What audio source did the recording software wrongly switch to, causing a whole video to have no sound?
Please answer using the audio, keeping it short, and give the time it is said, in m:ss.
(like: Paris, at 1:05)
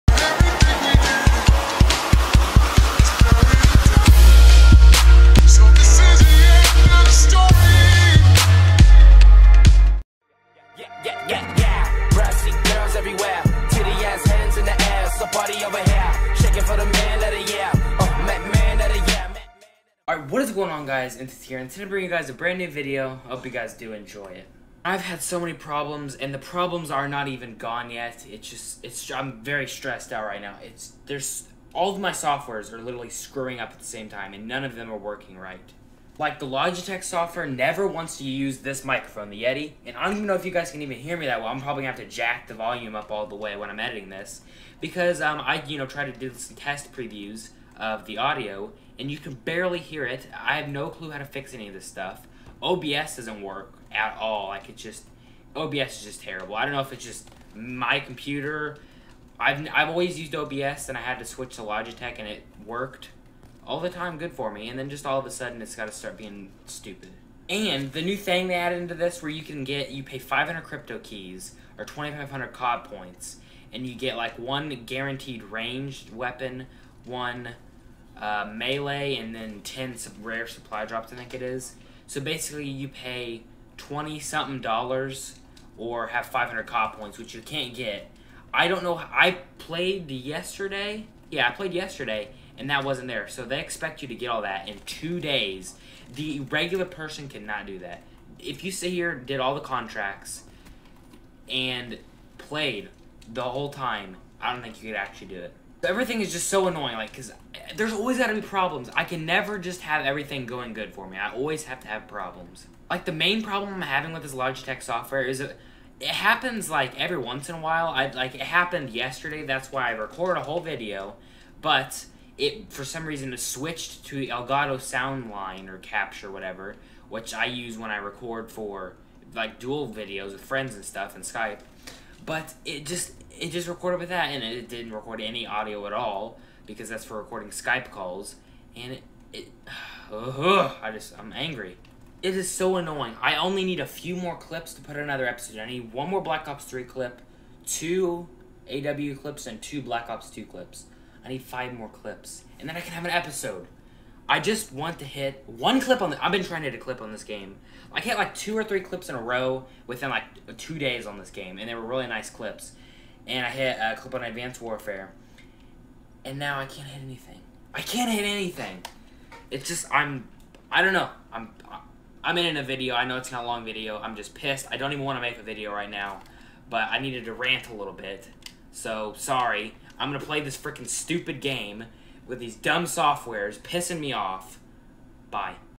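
Elgato Soundline, at 2:04.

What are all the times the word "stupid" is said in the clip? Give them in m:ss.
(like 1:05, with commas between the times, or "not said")
1:06, 3:00.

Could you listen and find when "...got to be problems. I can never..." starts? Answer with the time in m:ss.
1:48.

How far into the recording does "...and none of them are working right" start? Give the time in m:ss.
0:34.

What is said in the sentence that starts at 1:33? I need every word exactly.
So they expect you to get all that in two days.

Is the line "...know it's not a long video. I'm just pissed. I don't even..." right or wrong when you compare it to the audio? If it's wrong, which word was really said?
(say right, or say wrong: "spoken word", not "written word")
right.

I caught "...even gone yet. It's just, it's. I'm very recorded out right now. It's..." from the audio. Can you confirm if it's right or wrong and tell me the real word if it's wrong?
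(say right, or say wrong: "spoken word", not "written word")
wrong: "stressed", not "recorded".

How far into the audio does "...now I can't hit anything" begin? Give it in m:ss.
2:46.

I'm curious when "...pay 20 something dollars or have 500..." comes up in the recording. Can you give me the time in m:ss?
1:22.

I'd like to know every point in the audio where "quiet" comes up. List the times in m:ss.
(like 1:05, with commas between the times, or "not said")
not said.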